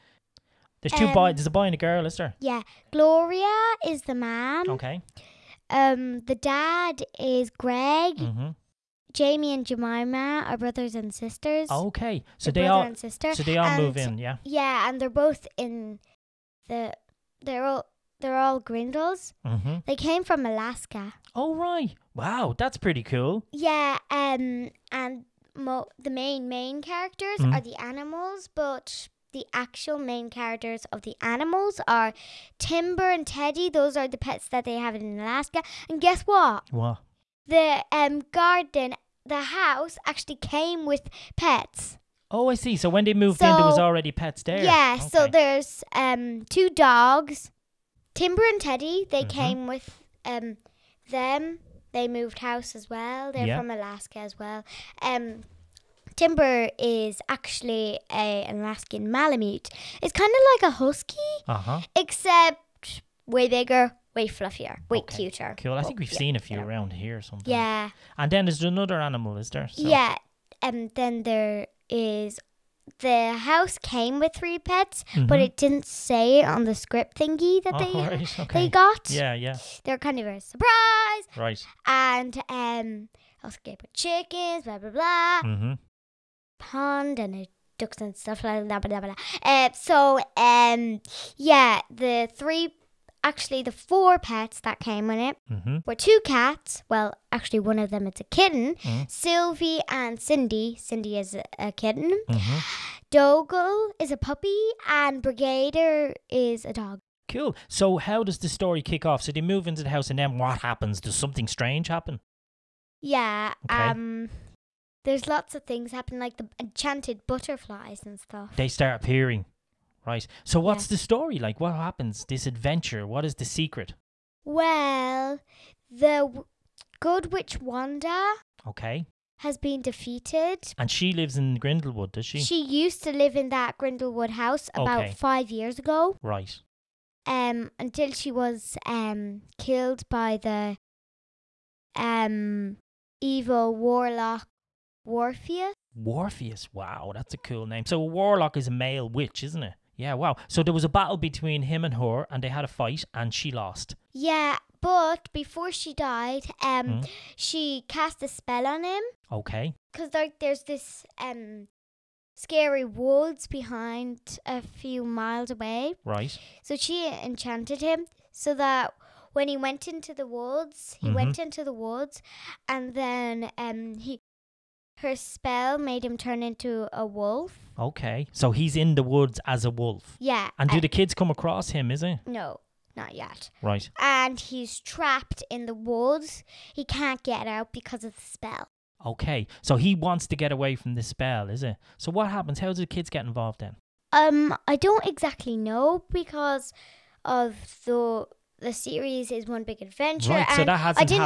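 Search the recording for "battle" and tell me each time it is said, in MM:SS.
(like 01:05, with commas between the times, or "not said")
02:30.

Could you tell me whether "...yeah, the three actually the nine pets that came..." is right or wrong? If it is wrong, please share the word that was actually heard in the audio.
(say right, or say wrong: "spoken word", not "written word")
wrong: "four", not "nine".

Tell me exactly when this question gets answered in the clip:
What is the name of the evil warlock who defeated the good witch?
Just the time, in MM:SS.
02:23.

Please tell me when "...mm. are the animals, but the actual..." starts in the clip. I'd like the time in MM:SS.
00:27.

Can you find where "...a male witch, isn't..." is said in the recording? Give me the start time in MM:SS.
02:28.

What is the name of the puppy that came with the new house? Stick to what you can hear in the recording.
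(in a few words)
Dougal.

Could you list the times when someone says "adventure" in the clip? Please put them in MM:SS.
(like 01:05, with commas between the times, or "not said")
02:02, 03:19.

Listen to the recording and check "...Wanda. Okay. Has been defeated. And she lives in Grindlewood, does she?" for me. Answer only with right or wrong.
right.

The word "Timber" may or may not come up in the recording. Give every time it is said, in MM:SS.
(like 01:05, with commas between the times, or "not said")
00:32, 00:48, 00:56.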